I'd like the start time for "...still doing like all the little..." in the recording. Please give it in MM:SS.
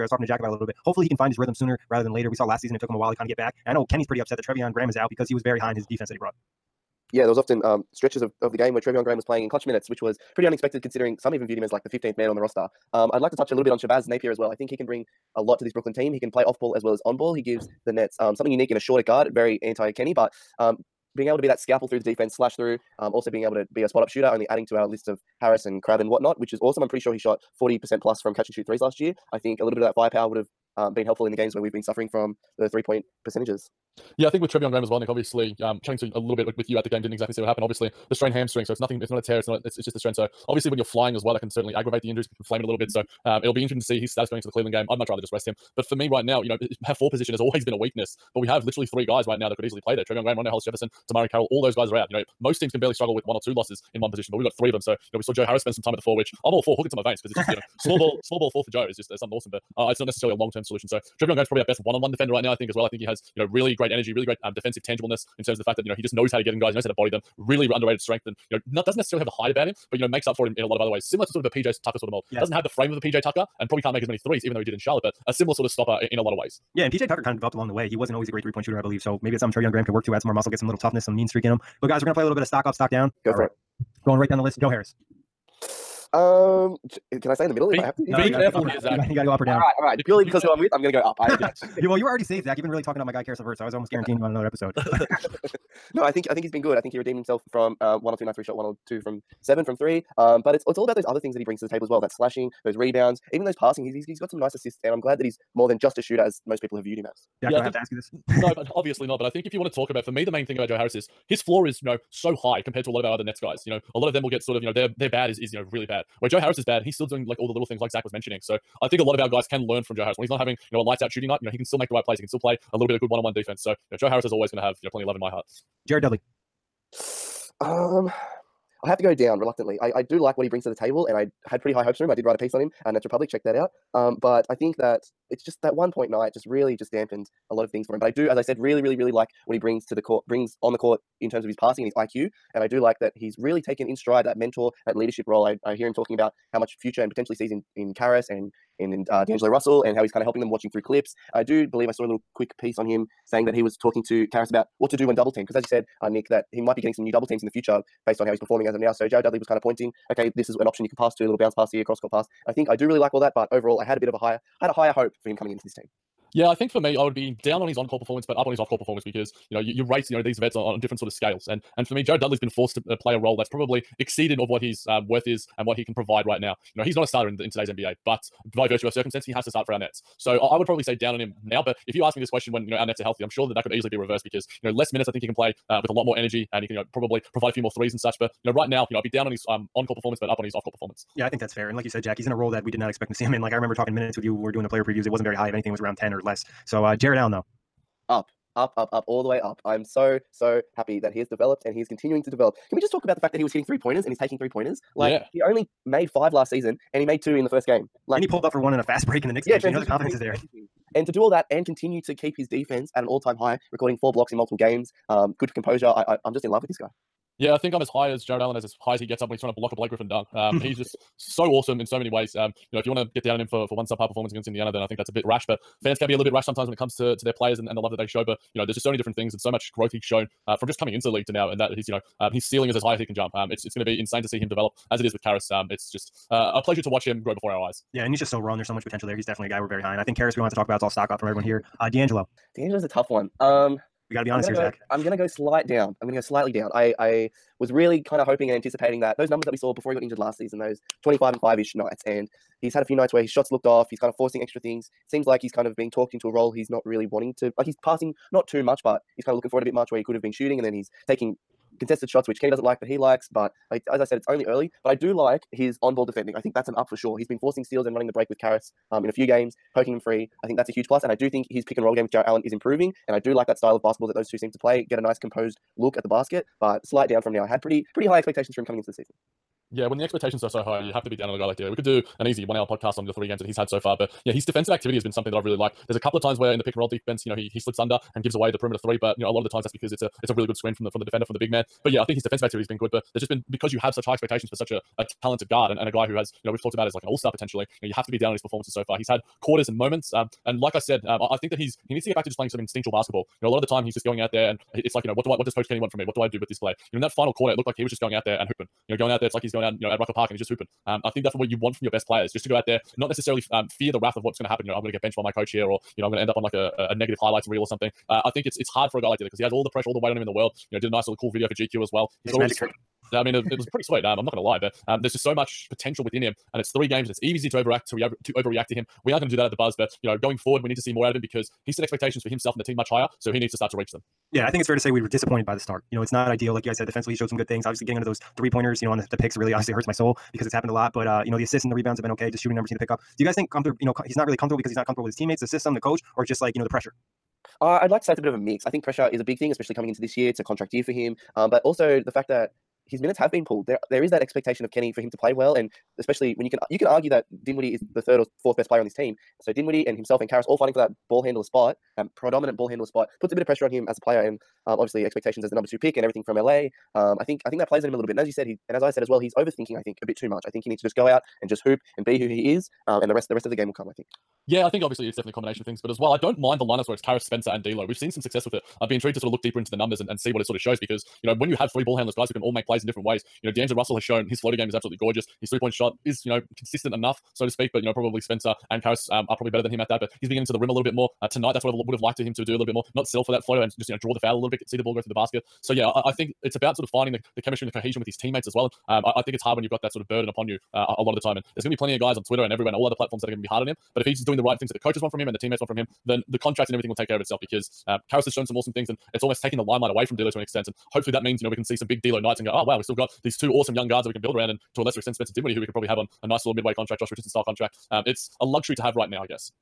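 01:56.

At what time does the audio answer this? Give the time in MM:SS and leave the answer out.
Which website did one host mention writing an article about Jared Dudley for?
02:12.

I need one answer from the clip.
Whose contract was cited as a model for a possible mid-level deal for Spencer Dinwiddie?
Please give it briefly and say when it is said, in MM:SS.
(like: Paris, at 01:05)
Josh Richardson, at 06:56.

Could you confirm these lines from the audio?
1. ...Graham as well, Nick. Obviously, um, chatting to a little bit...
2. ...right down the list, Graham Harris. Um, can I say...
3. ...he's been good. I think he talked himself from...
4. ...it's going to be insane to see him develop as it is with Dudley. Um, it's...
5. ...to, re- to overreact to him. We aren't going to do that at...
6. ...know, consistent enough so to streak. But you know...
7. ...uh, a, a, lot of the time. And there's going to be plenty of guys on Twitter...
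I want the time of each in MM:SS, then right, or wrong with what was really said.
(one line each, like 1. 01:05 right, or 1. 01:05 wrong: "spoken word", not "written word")
1. 00:34 right
2. 01:24 wrong: "Joe", not "Graham"
3. 01:36 wrong: "redeemed", not "talked"
4. 03:53 wrong: "Caris", not "Dudley"
5. 05:27 right
6. 06:26 wrong: "speak", not "streak"
7. 06:40 right.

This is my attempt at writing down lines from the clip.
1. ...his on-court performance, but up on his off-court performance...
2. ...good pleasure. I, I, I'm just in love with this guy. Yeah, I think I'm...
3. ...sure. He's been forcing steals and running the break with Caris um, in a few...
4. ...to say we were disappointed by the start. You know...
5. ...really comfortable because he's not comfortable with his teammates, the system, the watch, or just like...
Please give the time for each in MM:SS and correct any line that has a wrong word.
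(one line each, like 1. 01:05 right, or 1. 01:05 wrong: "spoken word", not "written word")
1. 02:47 right
2. 03:35 wrong: "composure", not "pleasure"
3. 04:26 right
4. 05:34 right
5. 05:44 wrong: "coach", not "watch".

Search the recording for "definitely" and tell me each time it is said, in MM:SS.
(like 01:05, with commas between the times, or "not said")
03:59, 06:15.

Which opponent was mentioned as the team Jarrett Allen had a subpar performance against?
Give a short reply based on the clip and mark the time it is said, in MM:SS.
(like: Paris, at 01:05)
Indiana, at 03:44.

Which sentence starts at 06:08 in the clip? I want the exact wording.
And as you said, he and as I said as well, he's overthinking.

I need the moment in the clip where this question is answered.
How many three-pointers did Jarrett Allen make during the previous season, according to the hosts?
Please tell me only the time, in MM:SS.
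03:26.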